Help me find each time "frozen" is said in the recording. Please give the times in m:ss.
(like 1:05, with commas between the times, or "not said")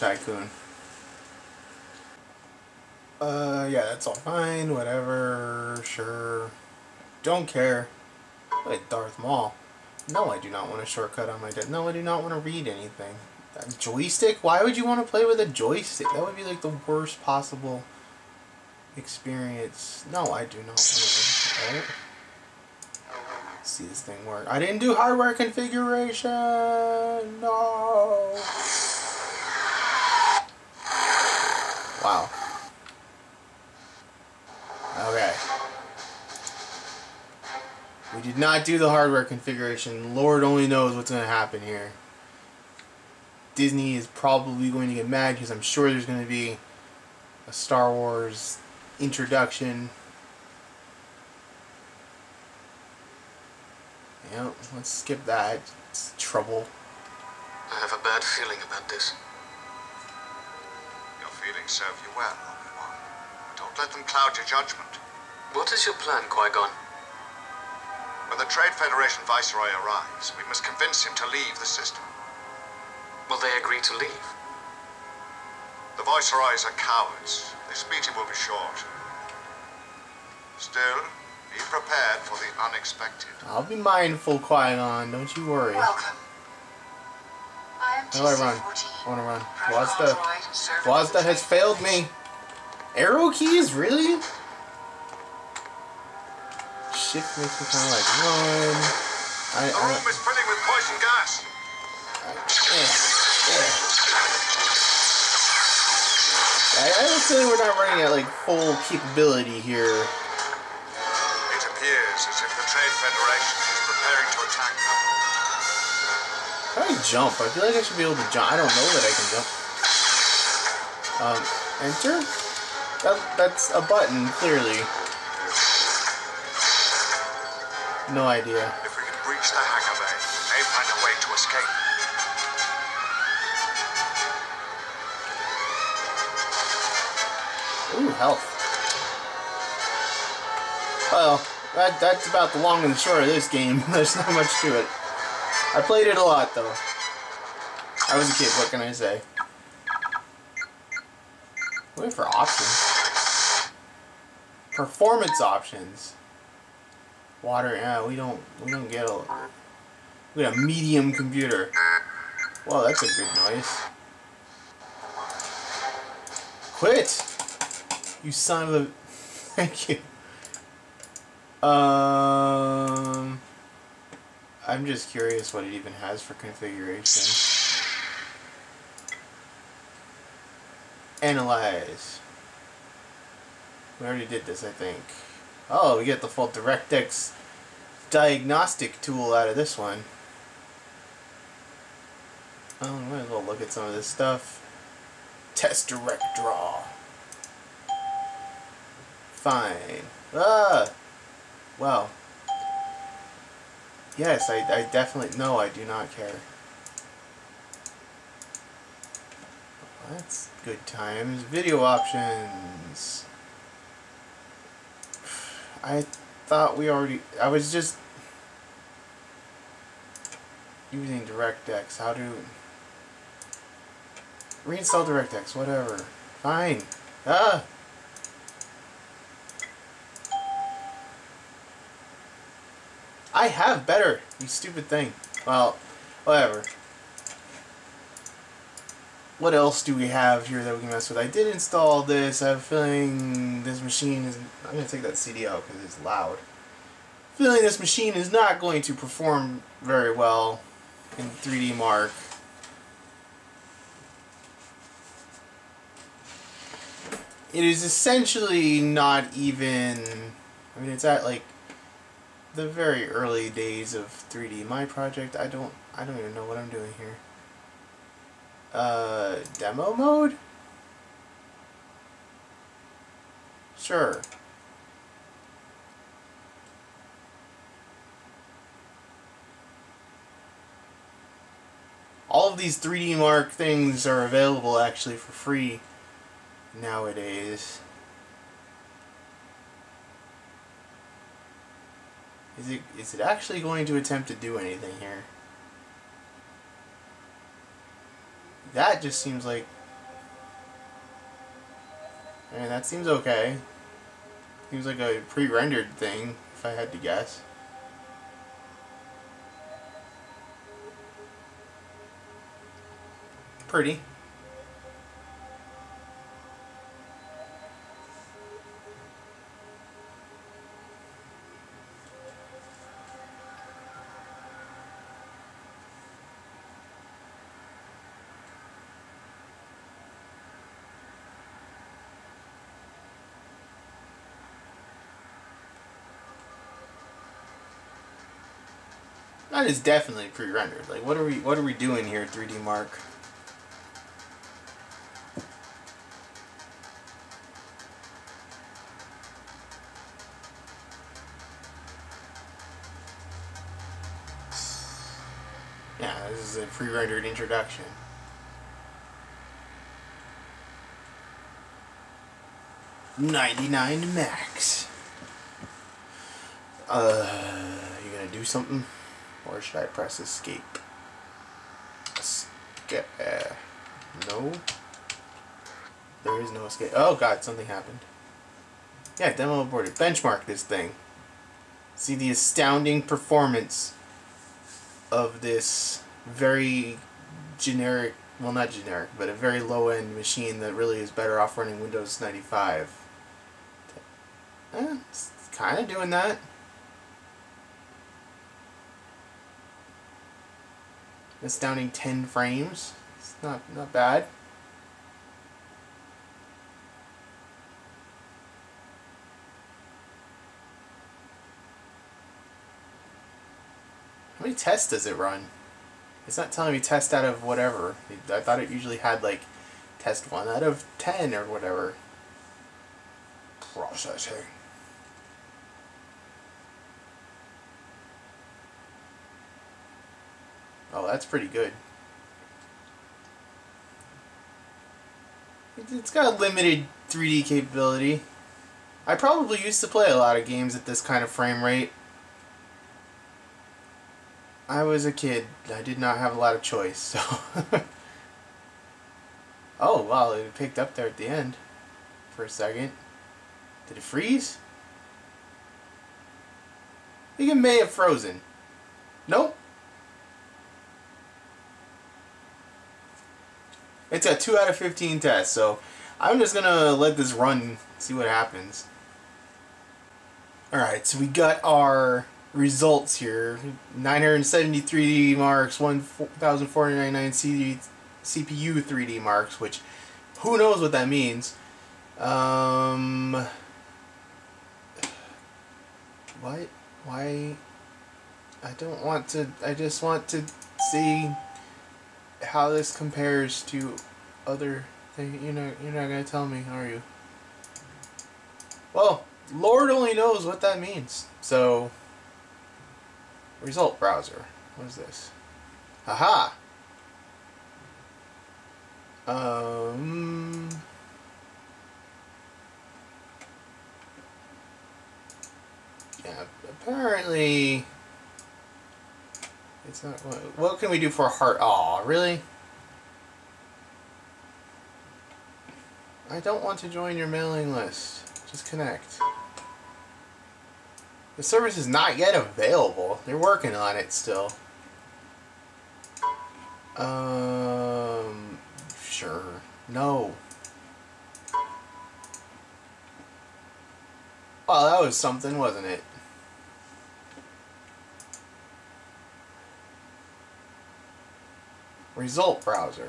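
7:37.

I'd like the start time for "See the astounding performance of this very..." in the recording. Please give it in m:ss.
6:21.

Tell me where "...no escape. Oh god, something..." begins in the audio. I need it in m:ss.
6:16.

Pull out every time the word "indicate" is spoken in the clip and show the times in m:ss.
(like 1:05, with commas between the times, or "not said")
not said.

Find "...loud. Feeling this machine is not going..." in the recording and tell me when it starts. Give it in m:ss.
4:06.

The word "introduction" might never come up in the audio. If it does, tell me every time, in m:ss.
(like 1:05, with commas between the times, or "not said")
0:49, 5:57.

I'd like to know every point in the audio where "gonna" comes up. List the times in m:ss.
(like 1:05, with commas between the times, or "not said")
6:08, 8:16.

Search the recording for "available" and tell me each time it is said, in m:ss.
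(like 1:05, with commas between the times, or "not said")
4:44, 8:52.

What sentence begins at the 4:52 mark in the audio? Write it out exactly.
Is it, is it actually going to attempt to do anything here?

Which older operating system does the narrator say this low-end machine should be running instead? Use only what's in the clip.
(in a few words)
Windows 95.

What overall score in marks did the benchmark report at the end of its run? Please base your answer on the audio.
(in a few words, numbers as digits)
973.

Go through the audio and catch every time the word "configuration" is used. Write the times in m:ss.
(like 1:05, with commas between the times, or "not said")
0:25, 0:39, 2:56.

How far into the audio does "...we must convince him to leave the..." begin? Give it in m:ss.
1:10.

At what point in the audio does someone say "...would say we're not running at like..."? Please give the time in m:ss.
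1:47.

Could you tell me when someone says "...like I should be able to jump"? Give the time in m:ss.
1:57.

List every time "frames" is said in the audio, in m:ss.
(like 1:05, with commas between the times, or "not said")
6:42, 7:21.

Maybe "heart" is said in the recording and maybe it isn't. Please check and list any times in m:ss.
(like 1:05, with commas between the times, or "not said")
8:41.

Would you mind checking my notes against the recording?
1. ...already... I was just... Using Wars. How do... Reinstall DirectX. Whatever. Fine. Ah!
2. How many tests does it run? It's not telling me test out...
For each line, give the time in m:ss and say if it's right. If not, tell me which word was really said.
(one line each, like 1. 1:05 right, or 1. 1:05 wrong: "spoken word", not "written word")
1. 3:36 wrong: "DirectX", not "Wars"
2. 6:54 right.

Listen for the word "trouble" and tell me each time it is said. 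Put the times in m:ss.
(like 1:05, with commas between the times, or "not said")
0:56.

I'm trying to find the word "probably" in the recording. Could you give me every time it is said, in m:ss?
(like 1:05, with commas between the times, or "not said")
0:44, 7:19.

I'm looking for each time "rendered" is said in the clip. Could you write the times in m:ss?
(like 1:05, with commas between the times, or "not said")
5:05, 5:40, 5:56.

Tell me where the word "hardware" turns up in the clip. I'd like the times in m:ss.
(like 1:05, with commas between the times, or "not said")
0:24, 0:38.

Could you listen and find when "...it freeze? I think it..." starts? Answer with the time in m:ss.
7:33.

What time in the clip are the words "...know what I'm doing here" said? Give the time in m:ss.
4:26.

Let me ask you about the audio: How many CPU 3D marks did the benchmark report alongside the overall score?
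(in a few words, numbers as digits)
1,499.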